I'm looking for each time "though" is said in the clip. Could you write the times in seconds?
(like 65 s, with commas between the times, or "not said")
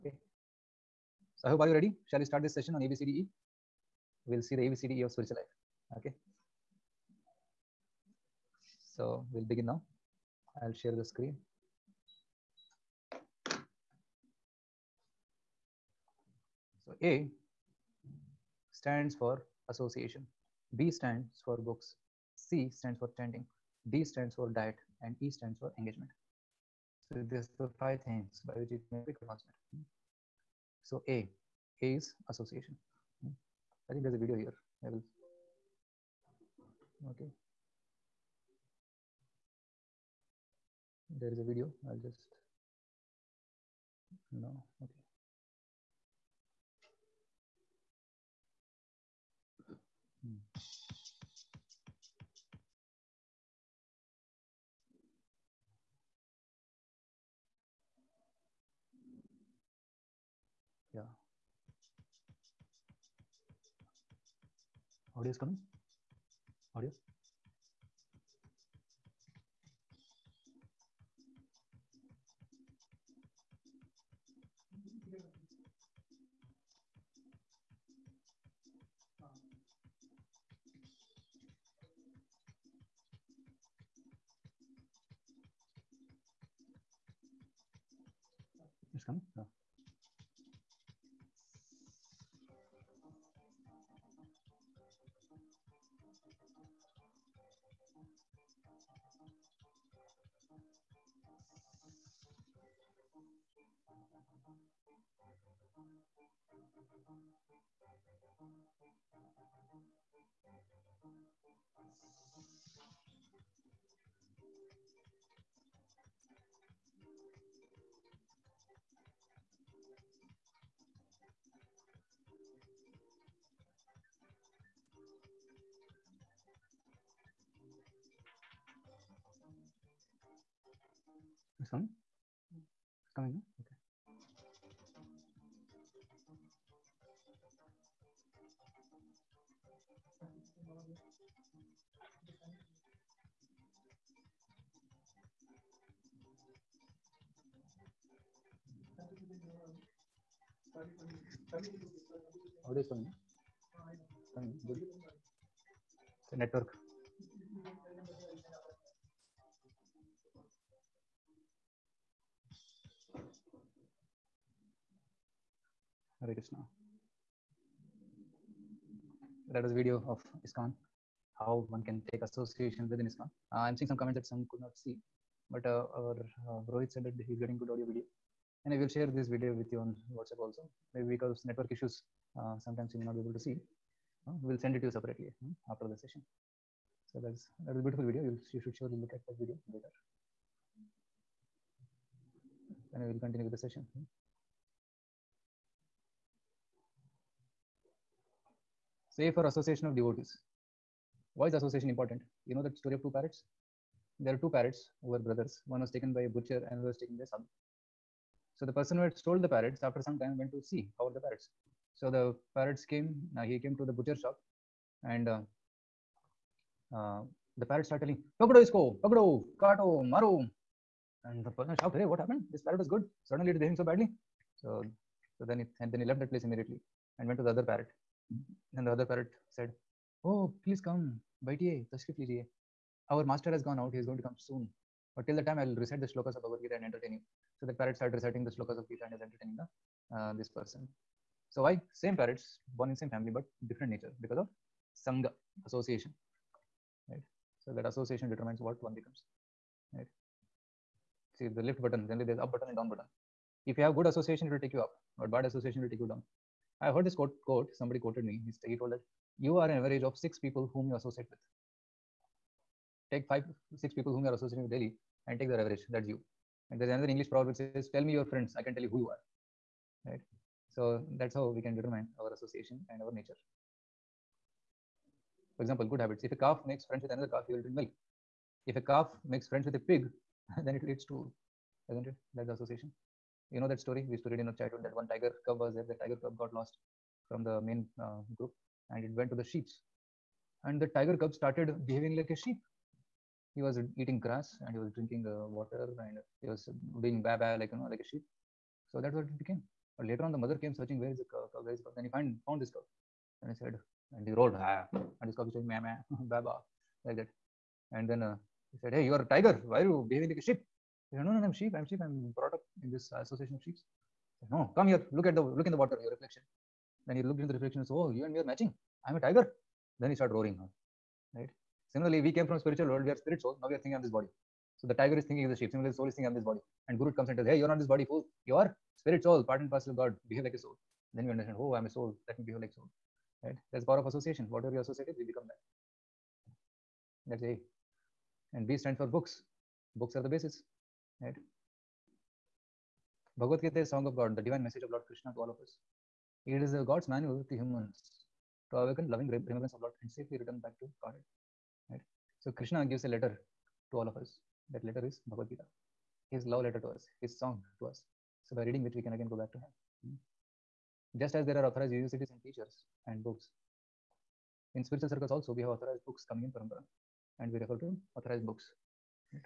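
not said.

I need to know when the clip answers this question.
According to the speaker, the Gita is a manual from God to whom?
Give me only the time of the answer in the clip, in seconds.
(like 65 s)
347 s.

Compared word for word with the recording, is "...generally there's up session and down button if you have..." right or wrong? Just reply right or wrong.
wrong.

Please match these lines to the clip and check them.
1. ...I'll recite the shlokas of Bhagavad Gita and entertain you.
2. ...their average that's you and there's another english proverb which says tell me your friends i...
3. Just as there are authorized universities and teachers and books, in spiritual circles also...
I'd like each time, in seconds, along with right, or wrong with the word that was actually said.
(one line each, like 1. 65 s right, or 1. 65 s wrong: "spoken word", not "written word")
1. 235 s right
2. 265 s right
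3. 361 s right.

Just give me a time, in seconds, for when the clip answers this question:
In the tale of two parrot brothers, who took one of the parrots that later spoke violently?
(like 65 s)
206 s.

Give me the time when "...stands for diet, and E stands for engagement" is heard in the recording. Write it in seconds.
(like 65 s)
24 s.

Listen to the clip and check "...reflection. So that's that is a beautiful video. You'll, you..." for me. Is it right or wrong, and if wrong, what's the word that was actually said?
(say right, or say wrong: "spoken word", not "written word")
wrong: "session", not "reflection".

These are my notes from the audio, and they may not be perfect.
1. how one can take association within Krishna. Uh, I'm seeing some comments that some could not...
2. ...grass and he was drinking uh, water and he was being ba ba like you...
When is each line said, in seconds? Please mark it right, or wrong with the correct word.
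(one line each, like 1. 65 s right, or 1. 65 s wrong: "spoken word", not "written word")
1. 171 s wrong: "ISKCON", not "Krishna"
2. 294 s right.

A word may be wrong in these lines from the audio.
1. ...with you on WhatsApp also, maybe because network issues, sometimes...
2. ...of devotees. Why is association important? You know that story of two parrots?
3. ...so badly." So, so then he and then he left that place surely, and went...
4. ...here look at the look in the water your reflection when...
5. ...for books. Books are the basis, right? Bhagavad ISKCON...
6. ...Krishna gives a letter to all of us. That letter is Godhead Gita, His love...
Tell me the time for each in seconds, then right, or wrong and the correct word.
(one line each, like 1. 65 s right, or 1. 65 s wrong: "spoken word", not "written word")
1. 179 s right
2. 199 s right
3. 223 s wrong: "immediately", not "surely"
4. 314 s right
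5. 338 s wrong: "Gita", not "ISKCON"
6. 352 s wrong: "Bhagavad", not "Godhead".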